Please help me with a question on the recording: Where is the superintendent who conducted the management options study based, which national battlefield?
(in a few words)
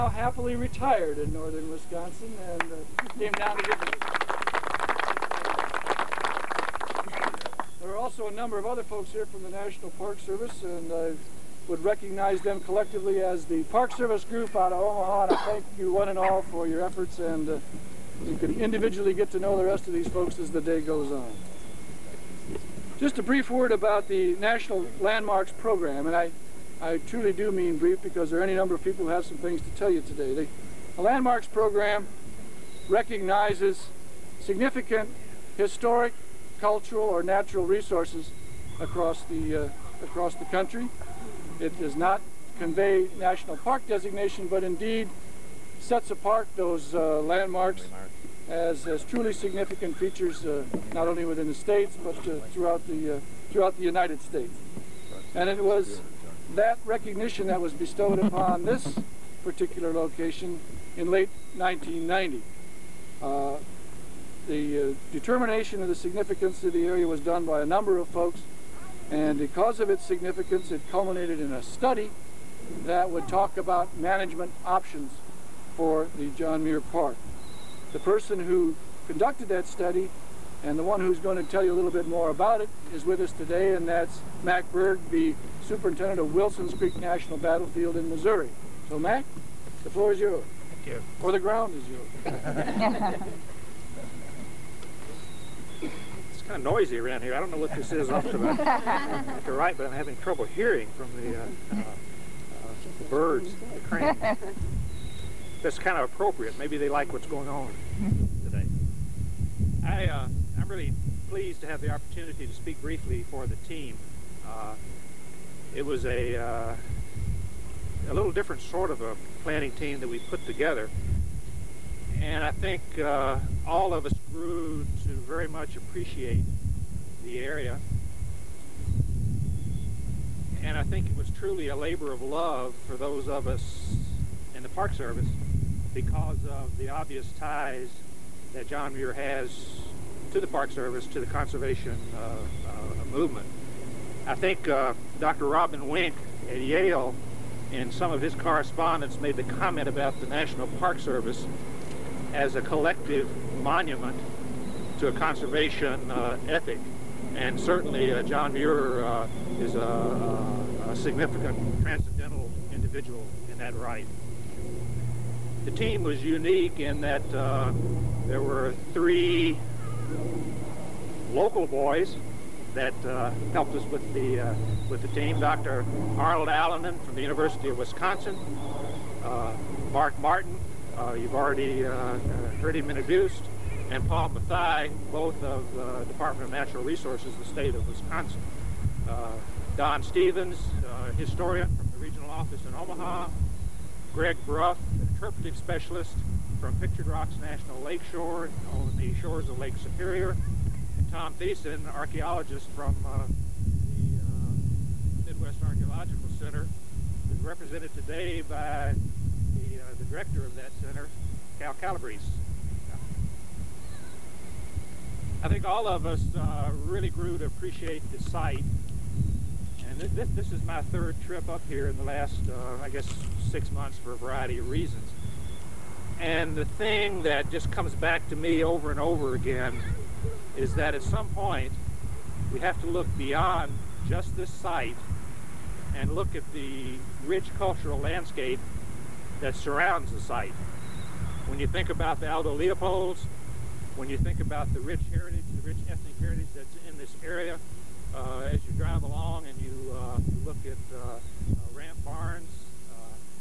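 Wilson's Creek National Battlefield.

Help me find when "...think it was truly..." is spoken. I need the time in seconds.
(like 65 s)
130 s.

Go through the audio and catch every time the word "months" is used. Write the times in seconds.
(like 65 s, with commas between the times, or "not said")
223 s.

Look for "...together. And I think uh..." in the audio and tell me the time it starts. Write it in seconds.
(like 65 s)
120 s.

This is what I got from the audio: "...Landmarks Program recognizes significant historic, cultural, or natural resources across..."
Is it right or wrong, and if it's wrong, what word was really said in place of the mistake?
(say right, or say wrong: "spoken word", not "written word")
right.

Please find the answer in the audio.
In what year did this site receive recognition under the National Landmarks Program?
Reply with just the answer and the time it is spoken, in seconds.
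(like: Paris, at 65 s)
1990, at 61 s.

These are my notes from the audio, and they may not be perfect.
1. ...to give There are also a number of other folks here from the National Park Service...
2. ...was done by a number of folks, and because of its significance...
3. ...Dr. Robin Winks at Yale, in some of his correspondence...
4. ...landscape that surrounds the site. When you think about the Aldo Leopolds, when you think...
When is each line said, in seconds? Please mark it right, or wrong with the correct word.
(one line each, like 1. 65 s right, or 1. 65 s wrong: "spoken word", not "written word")
1. 3 s right
2. 67 s right
3. 145 s right
4. 237 s right.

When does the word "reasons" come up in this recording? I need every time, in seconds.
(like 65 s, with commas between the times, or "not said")
224 s.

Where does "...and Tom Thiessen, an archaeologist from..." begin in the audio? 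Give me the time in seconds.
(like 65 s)
200 s.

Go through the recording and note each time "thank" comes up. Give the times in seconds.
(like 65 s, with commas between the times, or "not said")
15 s, 90 s.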